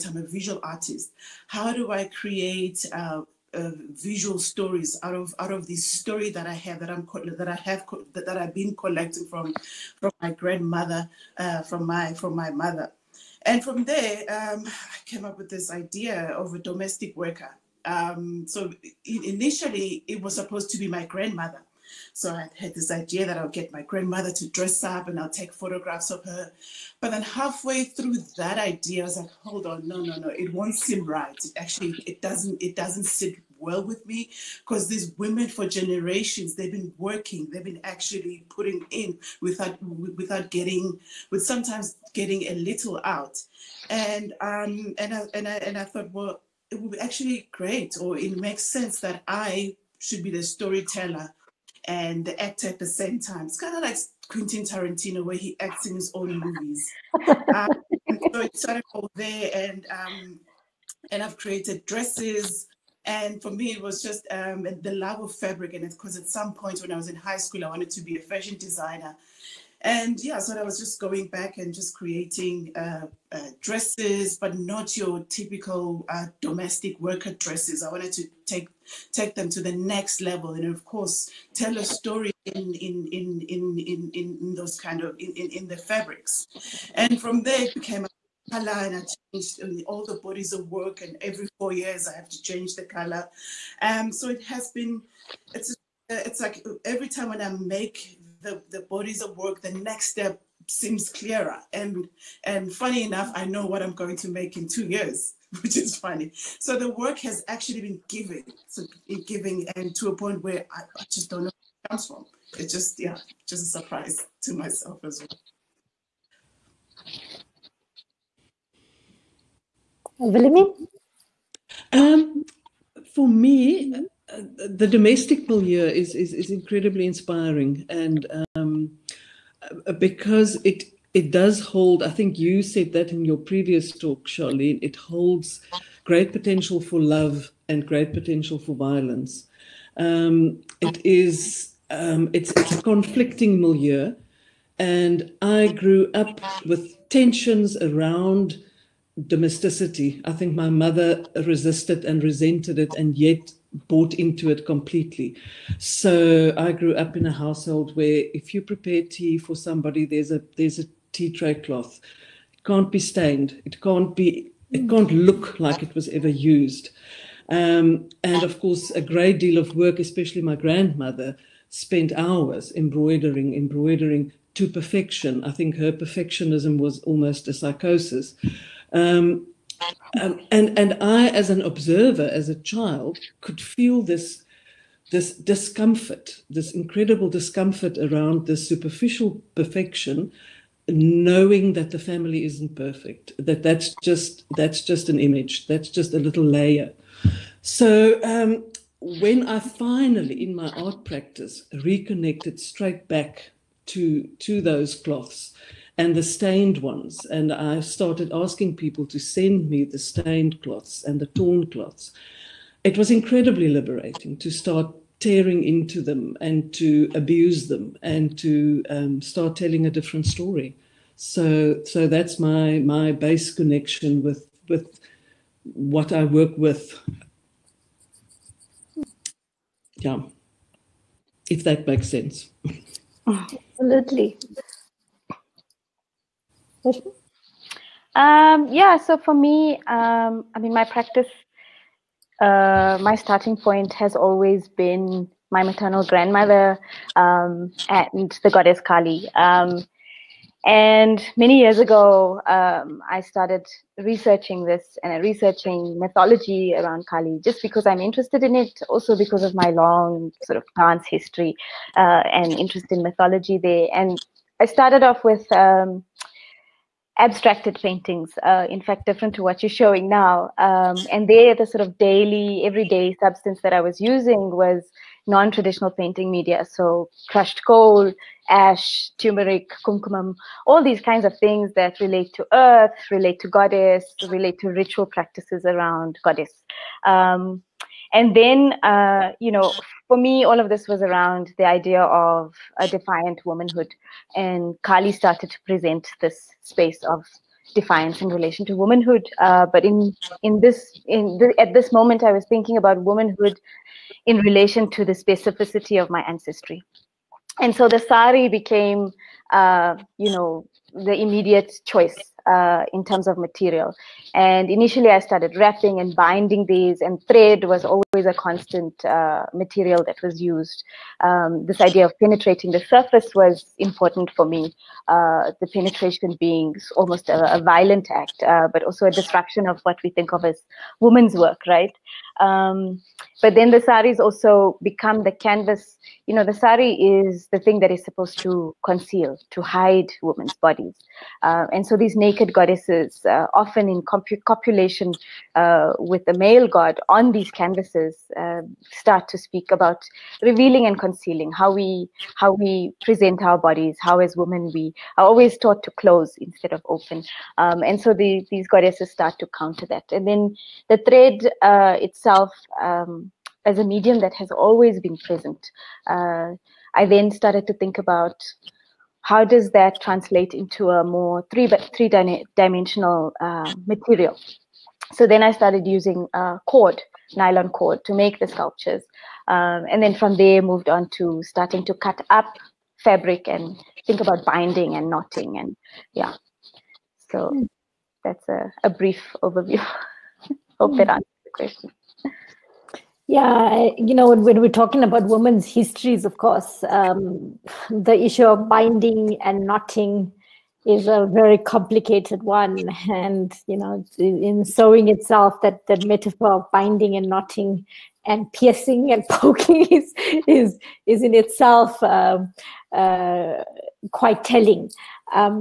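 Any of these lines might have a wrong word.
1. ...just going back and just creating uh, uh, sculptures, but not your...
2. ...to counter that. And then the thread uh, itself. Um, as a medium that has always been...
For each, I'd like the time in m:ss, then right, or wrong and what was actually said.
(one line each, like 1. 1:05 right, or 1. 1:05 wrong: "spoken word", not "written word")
1. 1:10 wrong: "dresses", not "sculptures"
2. 5:59 right.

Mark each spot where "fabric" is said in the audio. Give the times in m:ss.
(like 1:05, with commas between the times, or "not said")
1:05, 1:25, 6:23.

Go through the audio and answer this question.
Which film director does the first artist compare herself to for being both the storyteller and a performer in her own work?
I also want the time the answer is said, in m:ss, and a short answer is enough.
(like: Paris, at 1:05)
Quentin Tarantino, at 0:54.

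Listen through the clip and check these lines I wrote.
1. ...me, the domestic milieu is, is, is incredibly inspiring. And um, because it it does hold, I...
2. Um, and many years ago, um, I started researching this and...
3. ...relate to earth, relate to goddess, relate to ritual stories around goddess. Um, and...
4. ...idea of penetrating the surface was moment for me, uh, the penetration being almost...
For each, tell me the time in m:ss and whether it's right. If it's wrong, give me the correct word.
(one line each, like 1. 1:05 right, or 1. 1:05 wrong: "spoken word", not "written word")
1. 2:03 right
2. 4:09 right
3. 4:42 wrong: "practices", not "stories"
4. 5:21 wrong: "important", not "moment".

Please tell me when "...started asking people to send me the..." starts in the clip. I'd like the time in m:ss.
3:27.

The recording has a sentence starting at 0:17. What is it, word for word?
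Um, so initially, it was supposed to be my grandmother.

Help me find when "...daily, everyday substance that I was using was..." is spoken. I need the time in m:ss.
4:31.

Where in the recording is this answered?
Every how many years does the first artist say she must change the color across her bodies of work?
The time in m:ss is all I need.
1:31.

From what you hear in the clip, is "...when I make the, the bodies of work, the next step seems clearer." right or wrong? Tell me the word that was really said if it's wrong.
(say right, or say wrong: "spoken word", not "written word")
right.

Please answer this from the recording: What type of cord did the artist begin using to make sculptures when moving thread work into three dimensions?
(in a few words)
Nylon cord.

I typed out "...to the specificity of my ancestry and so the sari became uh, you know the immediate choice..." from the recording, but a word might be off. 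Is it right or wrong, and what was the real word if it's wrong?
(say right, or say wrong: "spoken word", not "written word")
right.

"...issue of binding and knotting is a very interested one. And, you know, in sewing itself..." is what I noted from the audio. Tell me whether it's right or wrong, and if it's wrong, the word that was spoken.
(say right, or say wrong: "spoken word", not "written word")
wrong: "complicated", not "interested".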